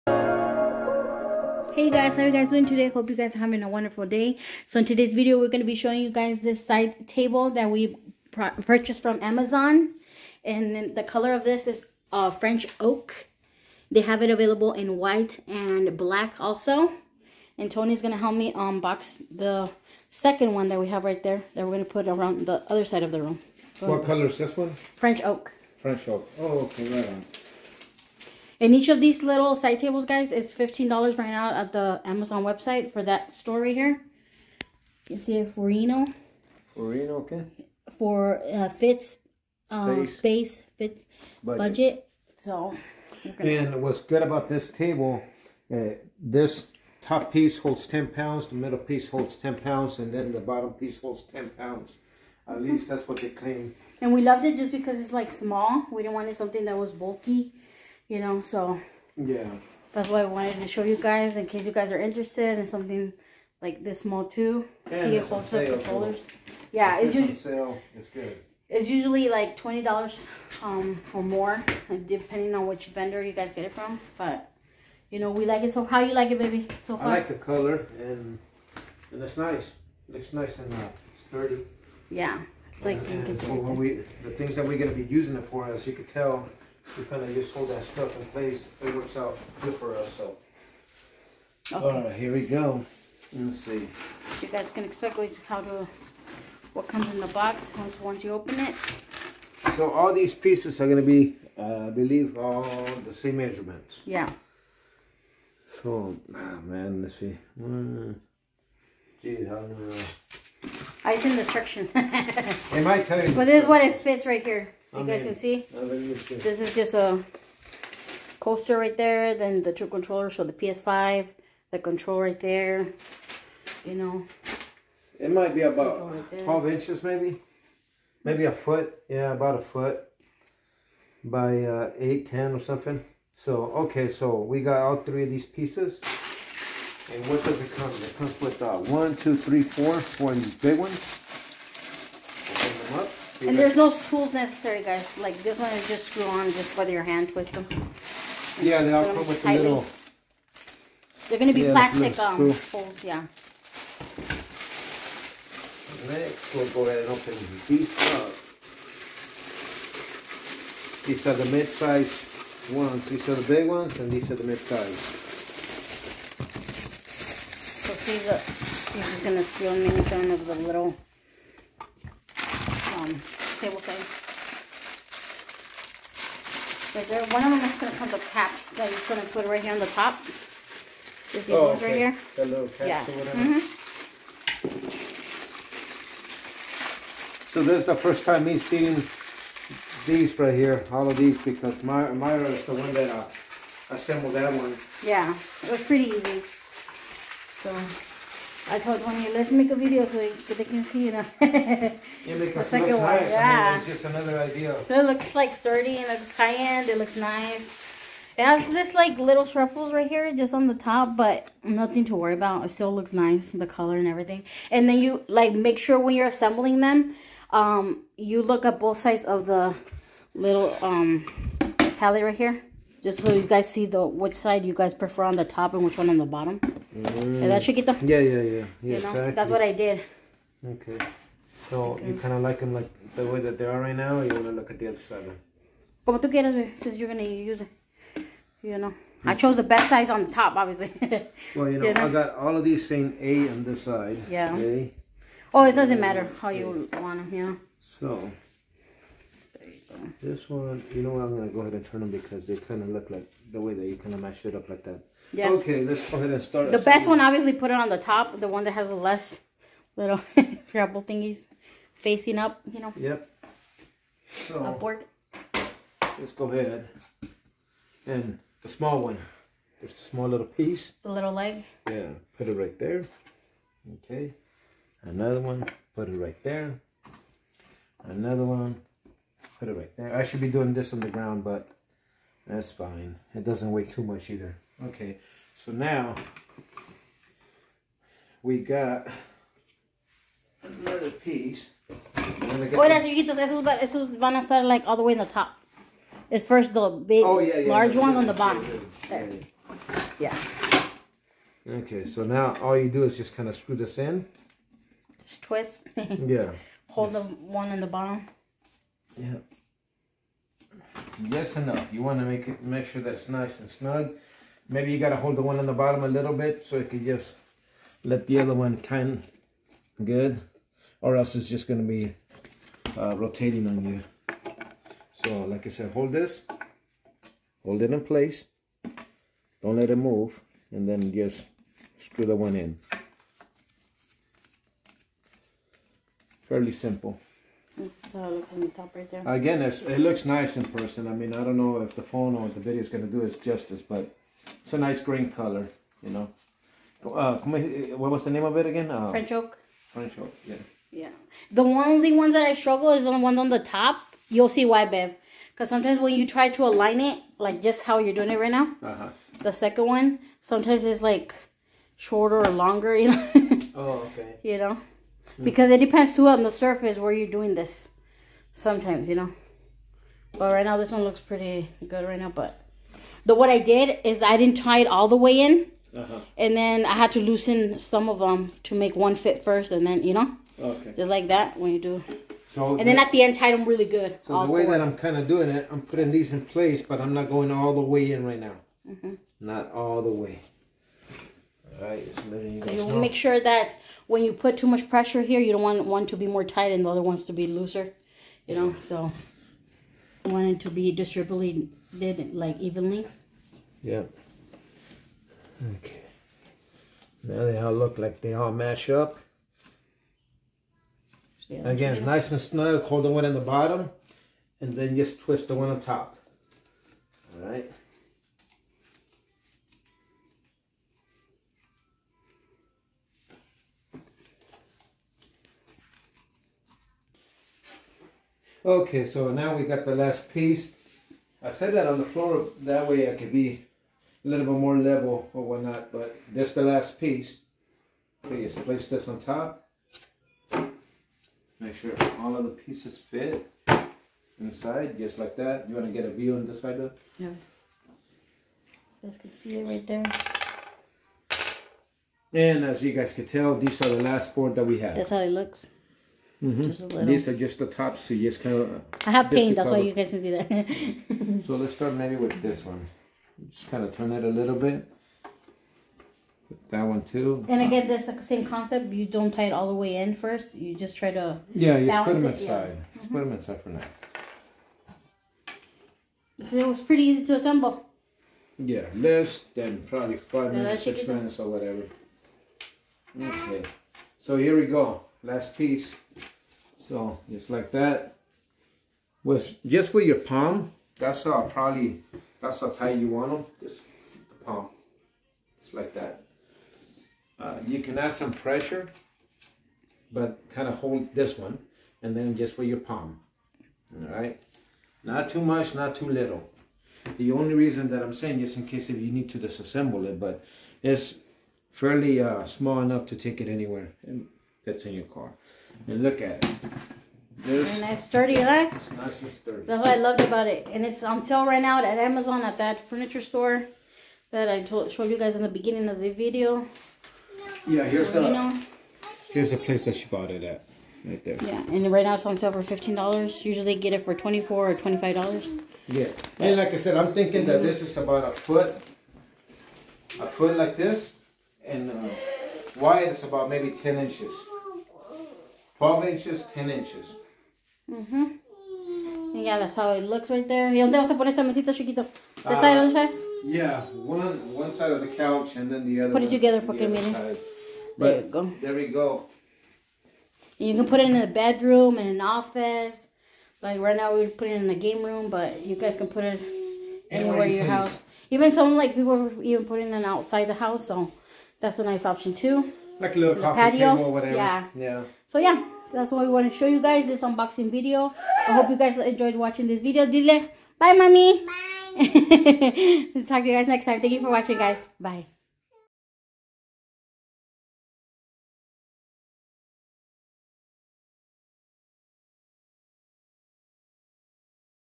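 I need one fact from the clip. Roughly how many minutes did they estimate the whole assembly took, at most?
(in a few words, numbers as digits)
6 minutes.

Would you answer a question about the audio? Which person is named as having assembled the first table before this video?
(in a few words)
Mayra.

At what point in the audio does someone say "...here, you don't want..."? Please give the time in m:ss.
6:35.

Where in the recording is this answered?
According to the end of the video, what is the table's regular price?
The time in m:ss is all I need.
8:54.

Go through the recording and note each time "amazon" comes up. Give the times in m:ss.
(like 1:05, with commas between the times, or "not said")
0:09, 0:32, 8:41.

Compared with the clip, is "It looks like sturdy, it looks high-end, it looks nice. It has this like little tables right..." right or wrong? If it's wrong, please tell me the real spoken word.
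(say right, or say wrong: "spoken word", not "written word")
wrong: "shuffles", not "tables".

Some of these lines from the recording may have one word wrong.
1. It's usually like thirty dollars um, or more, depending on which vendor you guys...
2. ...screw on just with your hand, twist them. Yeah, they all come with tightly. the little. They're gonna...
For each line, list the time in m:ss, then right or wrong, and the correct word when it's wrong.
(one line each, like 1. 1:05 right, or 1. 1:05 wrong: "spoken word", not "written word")
1. 1:08 wrong: "twenty", not "thirty"
2. 2:26 right.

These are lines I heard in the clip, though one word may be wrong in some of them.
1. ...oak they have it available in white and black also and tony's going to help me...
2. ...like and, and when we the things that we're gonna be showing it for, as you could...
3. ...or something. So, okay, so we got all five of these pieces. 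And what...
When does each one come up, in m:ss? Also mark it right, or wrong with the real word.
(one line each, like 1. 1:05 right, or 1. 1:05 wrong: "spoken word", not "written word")
1. 0:12 right
2. 1:22 wrong: "using", not "showing"
3. 2:12 wrong: "three", not "five".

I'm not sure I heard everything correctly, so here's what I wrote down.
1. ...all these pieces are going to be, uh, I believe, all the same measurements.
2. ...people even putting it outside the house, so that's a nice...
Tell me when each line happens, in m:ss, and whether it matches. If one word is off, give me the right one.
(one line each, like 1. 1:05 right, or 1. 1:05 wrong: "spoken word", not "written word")
1. 1:39 right
2. 9:28 right.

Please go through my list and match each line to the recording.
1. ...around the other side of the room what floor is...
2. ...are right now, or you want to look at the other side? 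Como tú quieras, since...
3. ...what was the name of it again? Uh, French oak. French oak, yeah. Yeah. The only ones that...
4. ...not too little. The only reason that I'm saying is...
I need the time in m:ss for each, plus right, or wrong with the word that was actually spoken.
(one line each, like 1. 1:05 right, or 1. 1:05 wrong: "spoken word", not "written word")
1. 0:22 wrong: "color", not "floor"
2. 3:53 right
3. 5:47 right
4. 8:25 right.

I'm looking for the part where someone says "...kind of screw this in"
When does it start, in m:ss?
5:03.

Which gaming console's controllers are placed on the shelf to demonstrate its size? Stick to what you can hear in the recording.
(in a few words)
PS5.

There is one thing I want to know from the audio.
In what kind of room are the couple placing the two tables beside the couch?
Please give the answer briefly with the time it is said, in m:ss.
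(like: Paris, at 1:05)
Game room, at 9:24.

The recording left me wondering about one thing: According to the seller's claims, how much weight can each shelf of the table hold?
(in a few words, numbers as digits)
10 pounds.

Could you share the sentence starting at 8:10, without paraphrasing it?
That's uh, probably that's how tight you want them.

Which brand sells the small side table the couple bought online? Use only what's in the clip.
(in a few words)
Furinno.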